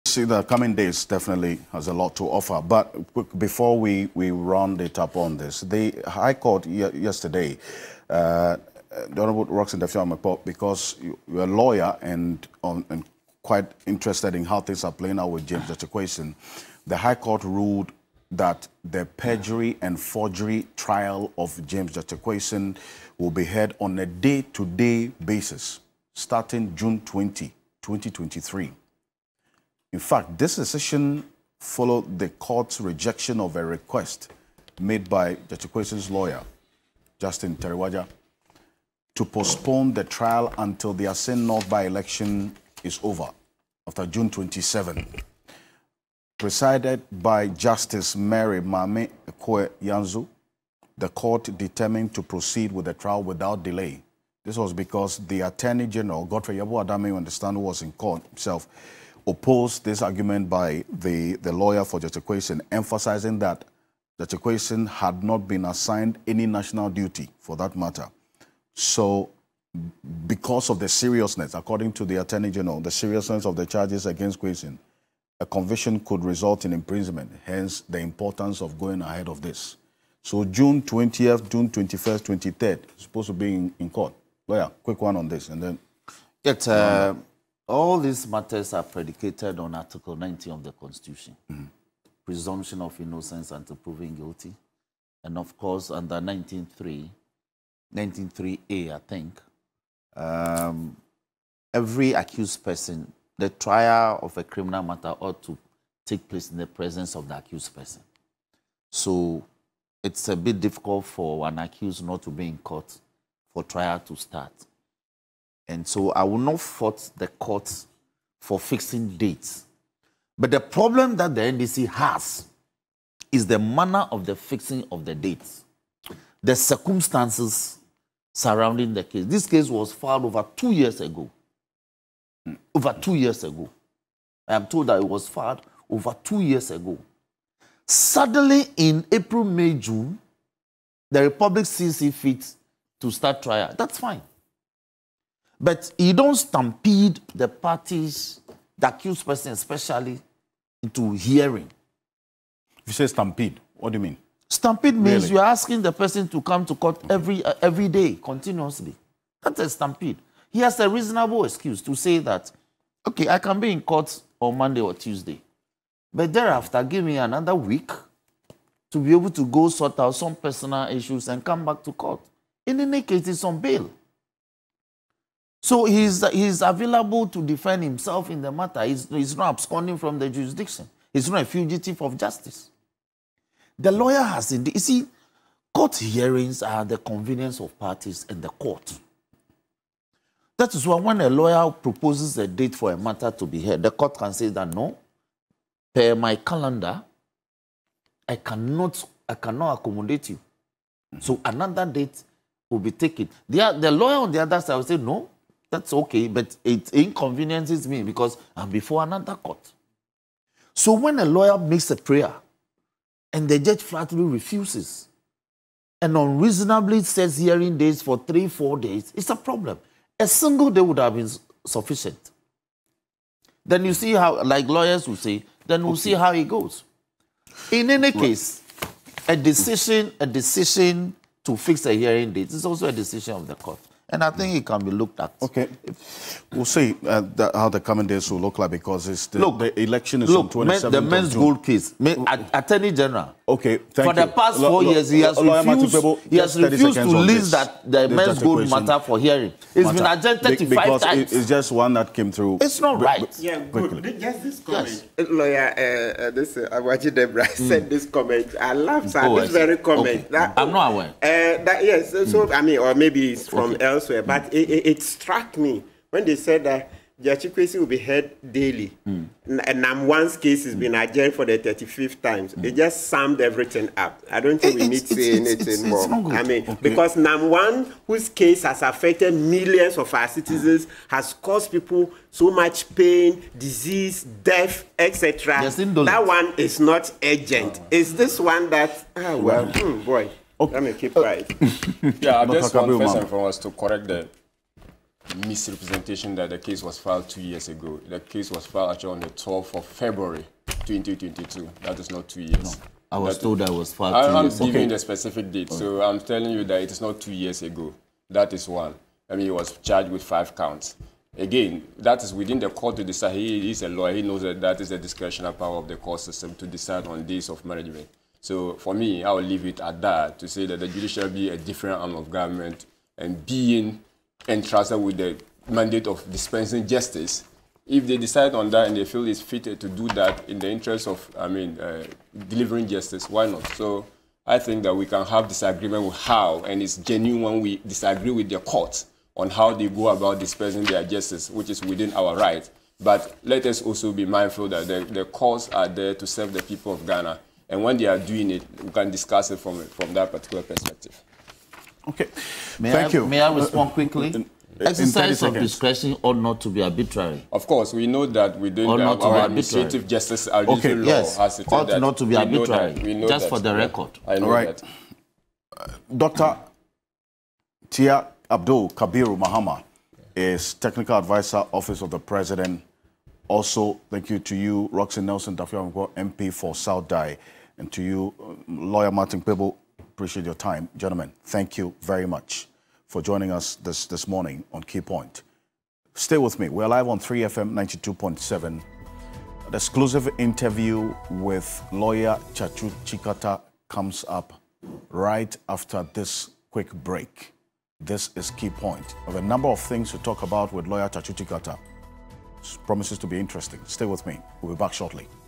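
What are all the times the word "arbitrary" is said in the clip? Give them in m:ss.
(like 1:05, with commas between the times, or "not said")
5:56, 6:02.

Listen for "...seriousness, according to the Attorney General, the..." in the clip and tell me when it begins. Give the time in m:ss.
1:10.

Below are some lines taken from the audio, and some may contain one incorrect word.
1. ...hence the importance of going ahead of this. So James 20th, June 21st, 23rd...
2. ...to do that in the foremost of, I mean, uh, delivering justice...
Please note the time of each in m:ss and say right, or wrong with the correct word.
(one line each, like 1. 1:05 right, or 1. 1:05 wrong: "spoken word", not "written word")
1. 1:17 wrong: "June", not "James"
2. 5:29 wrong: "interest", not "foremost".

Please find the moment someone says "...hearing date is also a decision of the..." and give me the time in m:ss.
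3:51.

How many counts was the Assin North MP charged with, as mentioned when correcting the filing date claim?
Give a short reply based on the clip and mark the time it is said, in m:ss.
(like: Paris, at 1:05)
5, at 5:10.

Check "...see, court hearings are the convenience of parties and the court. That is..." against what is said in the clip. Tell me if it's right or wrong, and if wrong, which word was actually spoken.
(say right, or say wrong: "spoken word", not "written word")
right.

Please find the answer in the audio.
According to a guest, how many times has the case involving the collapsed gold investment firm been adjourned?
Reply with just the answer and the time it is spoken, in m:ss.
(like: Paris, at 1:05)
35, at 4:10.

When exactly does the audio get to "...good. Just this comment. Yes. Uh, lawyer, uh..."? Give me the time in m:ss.
4:13.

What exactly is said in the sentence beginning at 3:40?
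A single day would have been sufficient.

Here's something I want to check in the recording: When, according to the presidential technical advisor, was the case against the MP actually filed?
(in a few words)
12th of February 2022.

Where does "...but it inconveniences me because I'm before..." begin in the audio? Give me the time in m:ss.
3:26.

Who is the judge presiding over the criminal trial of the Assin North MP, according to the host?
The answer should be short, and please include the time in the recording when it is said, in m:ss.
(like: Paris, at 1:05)
Justice Mary Mame Ekwe Yanzu, at 0:47.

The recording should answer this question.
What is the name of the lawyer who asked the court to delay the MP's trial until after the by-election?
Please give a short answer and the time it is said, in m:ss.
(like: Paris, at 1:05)
Justin Teriwajah, at 0:37.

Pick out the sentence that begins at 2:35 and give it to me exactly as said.
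you're asking the person to come to court every, uh, every day, continuously.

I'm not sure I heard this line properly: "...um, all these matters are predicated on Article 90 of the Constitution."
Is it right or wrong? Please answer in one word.
right.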